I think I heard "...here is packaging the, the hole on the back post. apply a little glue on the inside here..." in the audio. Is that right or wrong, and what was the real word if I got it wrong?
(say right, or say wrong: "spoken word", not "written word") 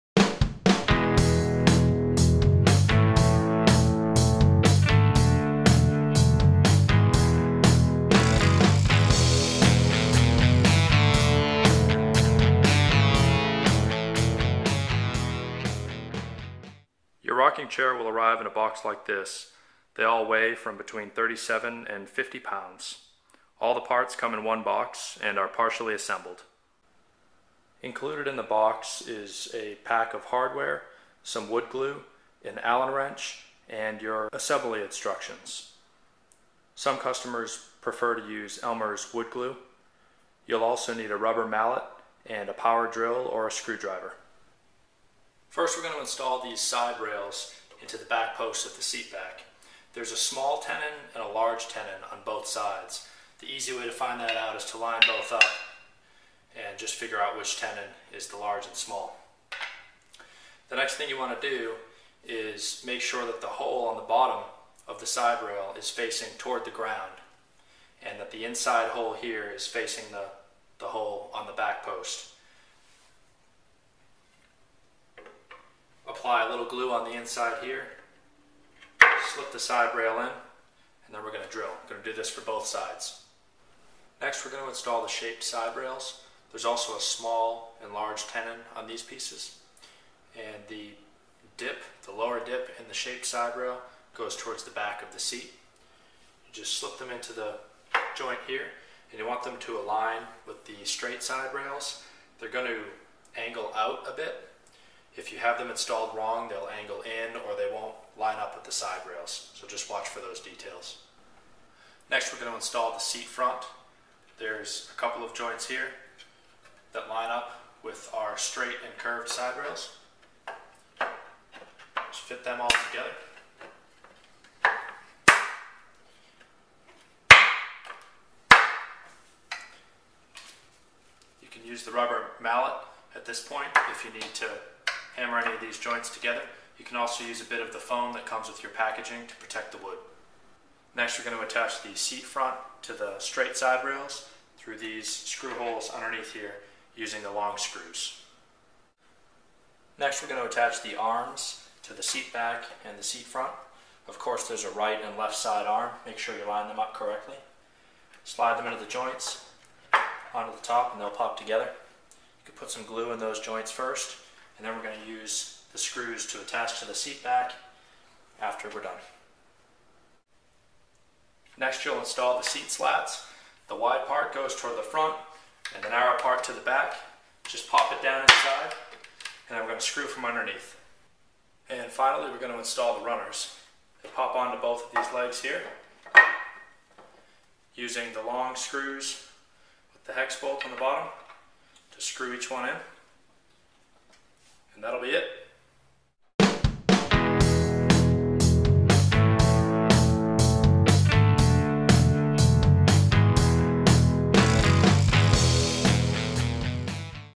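wrong: "facing", not "packaging".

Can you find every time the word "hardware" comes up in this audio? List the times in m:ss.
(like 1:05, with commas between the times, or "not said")
0:30.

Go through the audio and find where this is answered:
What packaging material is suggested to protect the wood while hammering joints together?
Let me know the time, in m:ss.
2:17.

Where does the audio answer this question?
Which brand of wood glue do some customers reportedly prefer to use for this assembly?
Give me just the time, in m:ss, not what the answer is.
0:38.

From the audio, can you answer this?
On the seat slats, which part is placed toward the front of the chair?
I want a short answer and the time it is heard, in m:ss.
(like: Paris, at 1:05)
the wide part, at 2:53.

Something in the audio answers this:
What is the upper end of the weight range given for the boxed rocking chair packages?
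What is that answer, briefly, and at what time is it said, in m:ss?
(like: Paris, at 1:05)
50 pounds, at 0:22.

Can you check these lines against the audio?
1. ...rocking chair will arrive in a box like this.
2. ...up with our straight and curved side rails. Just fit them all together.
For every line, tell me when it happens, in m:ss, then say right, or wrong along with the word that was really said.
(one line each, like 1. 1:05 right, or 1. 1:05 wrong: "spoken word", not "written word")
1. 0:17 right
2. 1:57 right.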